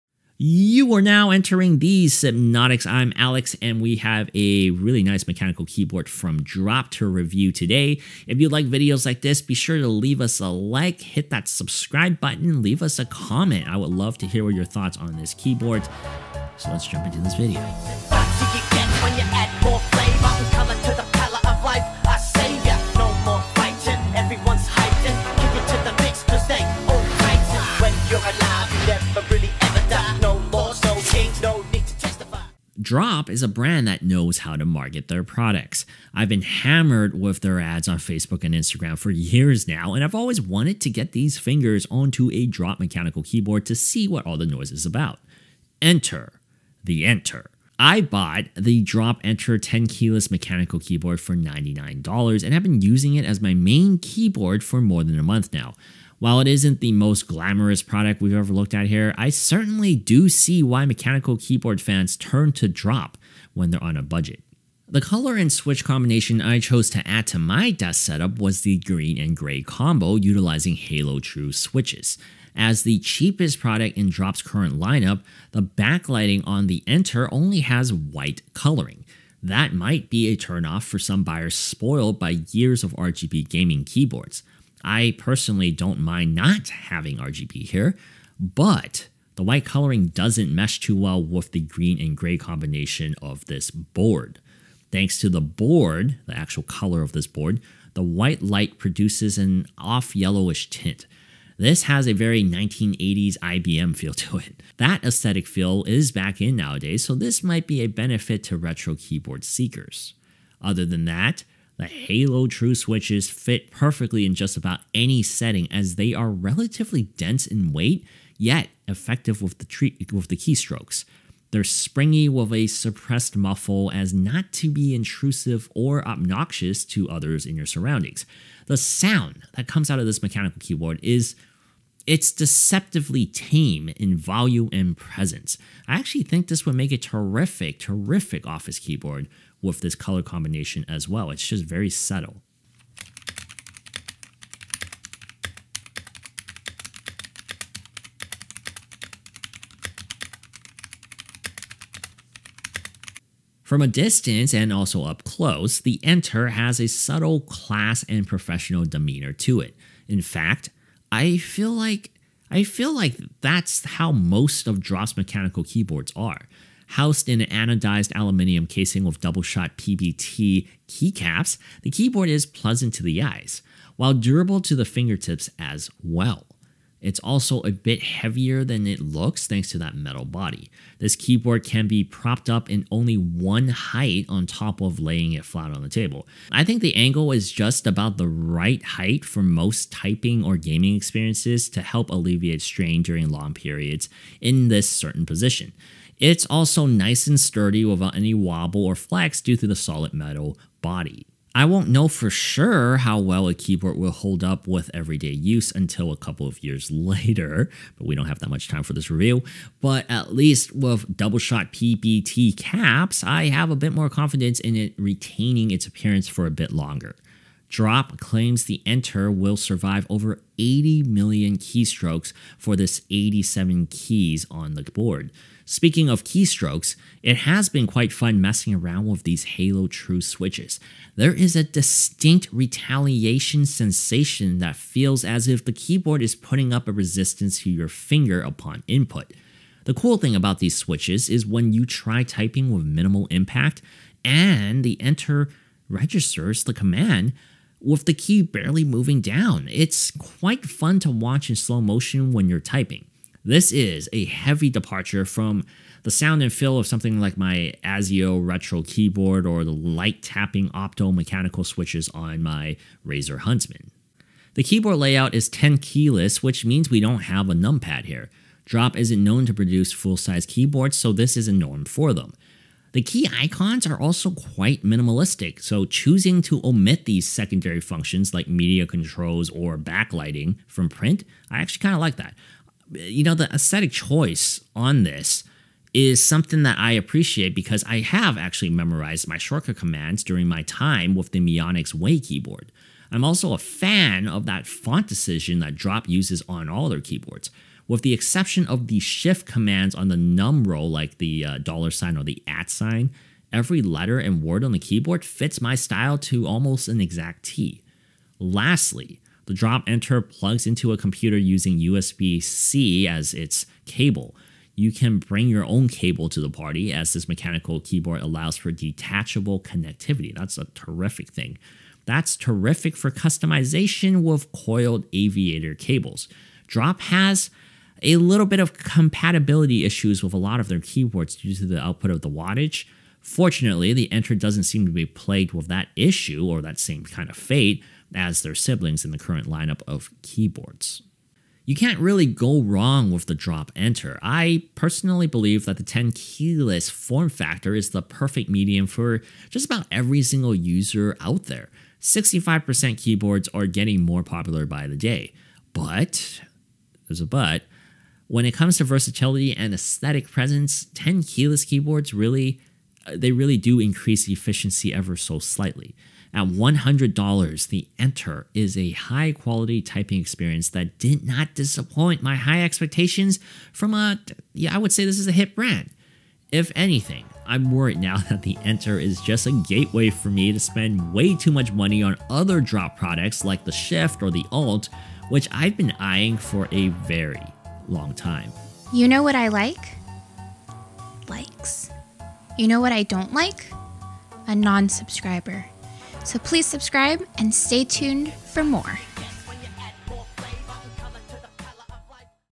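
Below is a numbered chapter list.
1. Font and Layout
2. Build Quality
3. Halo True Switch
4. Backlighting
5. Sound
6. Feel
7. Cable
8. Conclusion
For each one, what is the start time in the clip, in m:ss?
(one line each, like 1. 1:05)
1. 4:24
2. 2:33
3. 1:50
4. 1:04
5. 2:08
6. 3:50
7. 5:09
8. 5:41.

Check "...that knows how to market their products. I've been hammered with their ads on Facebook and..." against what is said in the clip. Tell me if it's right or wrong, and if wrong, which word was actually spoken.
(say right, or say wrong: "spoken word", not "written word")
right.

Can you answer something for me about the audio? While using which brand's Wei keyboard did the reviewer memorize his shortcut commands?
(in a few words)
Mionix.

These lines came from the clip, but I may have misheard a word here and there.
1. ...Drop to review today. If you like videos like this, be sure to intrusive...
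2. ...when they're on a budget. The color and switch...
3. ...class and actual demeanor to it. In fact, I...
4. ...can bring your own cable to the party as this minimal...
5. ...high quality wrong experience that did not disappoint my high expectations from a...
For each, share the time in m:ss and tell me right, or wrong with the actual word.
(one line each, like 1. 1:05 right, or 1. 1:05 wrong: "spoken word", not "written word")
1. 0:06 wrong: "leave", not "intrusive"
2. 1:03 right
3. 2:37 wrong: "professional", not "actual"
4. 5:14 wrong: "mechanical", not "minimal"
5. 6:08 wrong: "typing", not "wrong".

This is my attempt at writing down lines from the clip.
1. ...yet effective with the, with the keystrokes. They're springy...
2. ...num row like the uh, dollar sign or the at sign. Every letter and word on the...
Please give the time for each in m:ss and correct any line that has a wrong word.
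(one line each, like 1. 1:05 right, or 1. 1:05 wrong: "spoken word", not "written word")
1. 1:58 right
2. 5:00 right.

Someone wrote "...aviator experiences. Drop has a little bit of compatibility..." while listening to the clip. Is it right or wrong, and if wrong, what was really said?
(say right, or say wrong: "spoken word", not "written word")
wrong: "cables", not "experiences".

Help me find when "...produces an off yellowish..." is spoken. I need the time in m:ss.
1:38.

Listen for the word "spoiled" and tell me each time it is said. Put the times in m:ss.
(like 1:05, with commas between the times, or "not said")
1:21.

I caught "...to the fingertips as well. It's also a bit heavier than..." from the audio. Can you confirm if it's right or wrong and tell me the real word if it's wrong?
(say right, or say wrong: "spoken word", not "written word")
right.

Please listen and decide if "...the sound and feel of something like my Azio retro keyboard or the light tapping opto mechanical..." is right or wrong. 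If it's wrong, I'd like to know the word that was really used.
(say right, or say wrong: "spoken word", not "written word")
right.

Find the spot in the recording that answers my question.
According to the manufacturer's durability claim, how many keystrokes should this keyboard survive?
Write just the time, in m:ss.
3:40.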